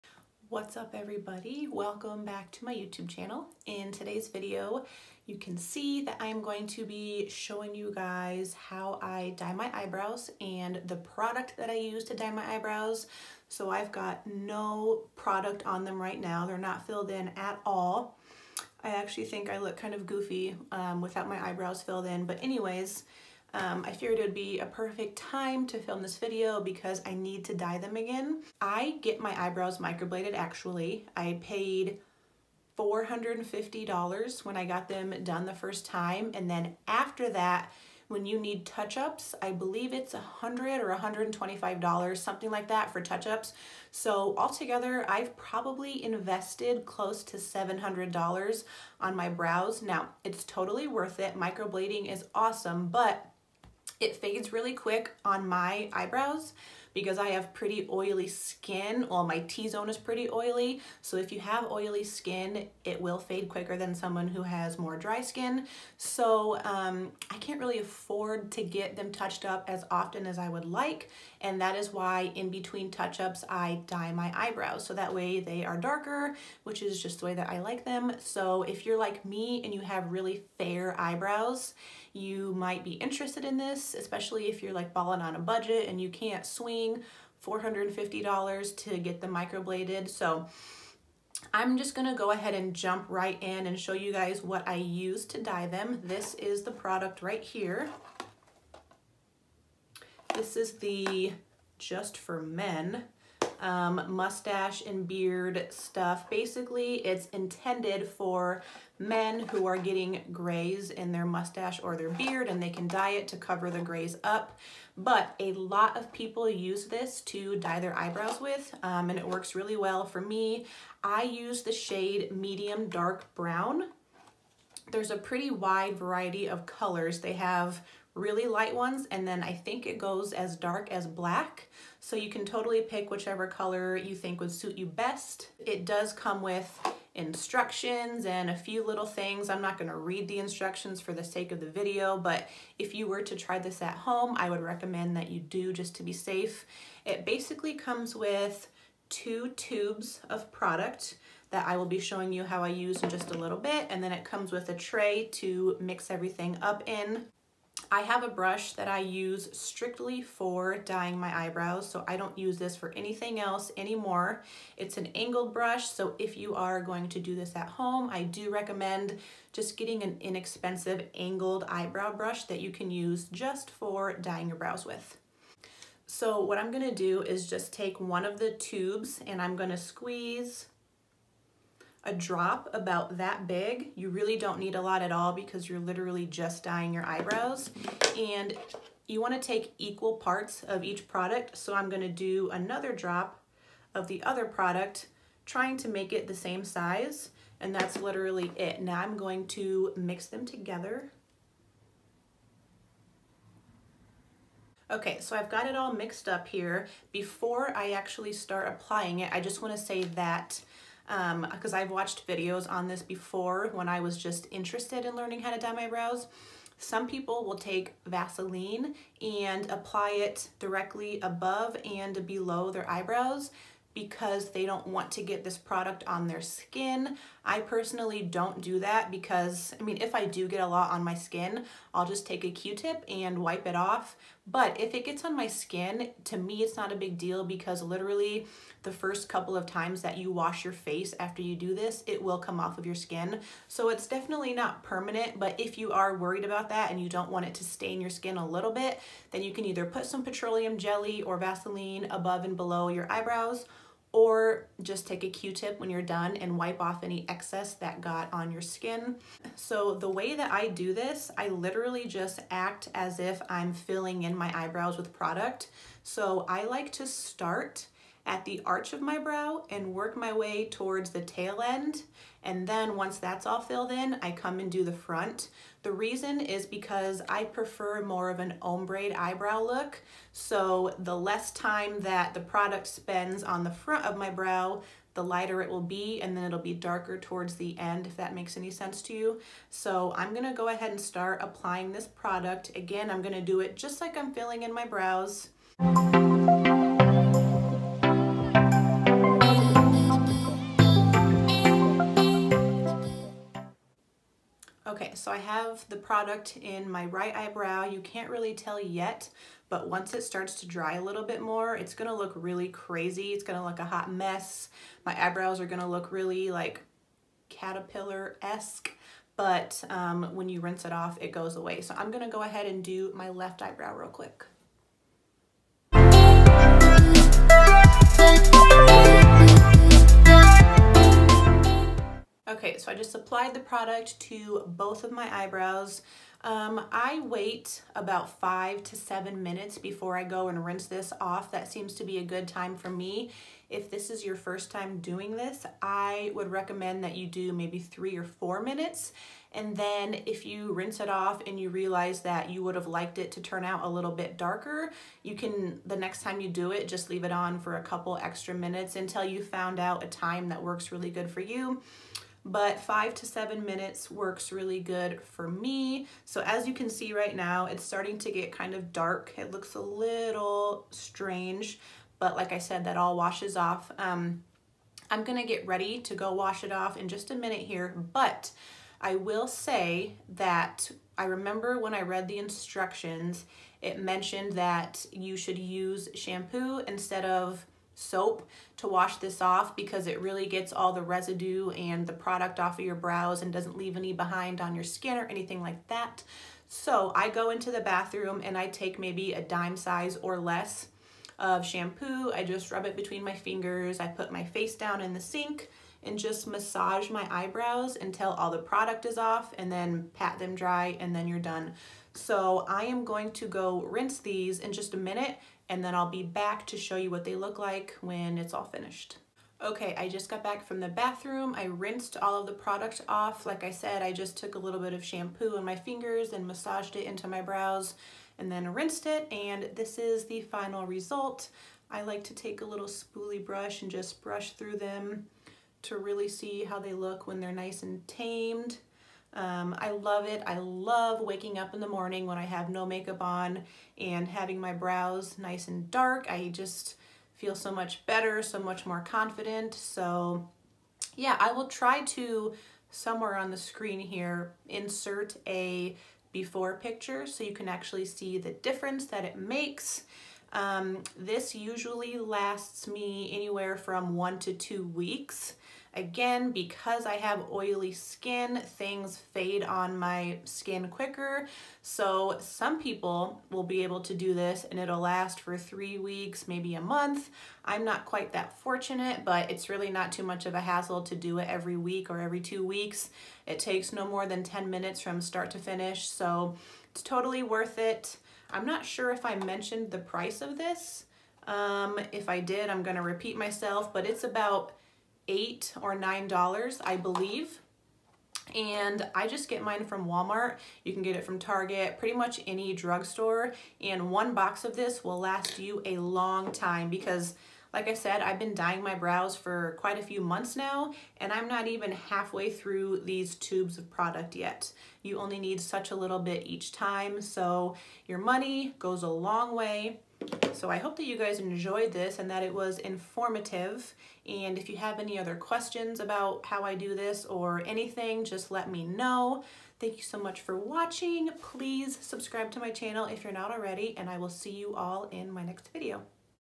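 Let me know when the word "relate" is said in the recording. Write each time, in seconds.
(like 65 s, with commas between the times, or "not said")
not said.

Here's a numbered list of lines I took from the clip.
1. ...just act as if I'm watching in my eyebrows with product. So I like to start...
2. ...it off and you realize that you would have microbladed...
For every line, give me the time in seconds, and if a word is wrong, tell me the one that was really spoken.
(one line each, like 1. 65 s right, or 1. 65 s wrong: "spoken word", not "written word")
1. 262 s wrong: "filling", not "watching"
2. 350 s wrong: "liked", not "microbladed".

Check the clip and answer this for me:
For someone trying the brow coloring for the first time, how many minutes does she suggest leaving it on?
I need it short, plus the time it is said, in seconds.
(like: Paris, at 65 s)
3 or 4 minutes, at 347 s.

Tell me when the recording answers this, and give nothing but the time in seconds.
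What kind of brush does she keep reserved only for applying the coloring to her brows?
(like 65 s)
165 s.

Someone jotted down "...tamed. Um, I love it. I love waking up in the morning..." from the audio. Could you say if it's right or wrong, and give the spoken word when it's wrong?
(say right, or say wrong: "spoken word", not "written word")
right.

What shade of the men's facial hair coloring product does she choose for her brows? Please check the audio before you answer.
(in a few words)
medium dark brown.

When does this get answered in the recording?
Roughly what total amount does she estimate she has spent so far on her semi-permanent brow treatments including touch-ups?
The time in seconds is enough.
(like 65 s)
46 s.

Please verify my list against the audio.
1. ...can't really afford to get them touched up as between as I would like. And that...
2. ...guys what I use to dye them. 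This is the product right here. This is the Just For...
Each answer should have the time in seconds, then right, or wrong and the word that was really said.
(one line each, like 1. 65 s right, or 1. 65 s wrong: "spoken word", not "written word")
1. 67 s wrong: "often", not "between"
2. 94 s right.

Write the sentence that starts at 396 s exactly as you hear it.
So I go into the bathroom and I take maybe a dime size or less of shampoo.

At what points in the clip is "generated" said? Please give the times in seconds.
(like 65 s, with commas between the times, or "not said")
not said.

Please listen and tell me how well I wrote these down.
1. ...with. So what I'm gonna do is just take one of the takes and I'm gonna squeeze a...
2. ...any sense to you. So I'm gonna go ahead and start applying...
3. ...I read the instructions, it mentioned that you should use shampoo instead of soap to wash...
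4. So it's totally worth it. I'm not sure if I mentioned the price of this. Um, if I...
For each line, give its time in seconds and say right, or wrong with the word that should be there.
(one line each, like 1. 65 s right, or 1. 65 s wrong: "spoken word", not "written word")
1. 174 s wrong: "tubes", not "takes"
2. 288 s right
3. 381 s right
4. 486 s right.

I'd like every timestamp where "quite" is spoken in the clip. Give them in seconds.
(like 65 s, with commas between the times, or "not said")
478 s, 509 s.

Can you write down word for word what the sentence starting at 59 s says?
Well, my T-zone is pretty oily.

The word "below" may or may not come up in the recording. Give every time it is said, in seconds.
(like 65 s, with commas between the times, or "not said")
222 s, 252 s.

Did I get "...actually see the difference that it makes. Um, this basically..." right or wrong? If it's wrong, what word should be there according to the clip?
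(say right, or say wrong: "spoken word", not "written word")
wrong: "usually", not "basically".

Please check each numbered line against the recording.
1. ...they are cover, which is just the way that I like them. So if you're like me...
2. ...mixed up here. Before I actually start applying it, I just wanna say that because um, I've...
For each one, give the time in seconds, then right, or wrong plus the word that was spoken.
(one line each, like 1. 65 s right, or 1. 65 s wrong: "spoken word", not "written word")
1. 75 s wrong: "darker", not "cover"
2. 205 s right.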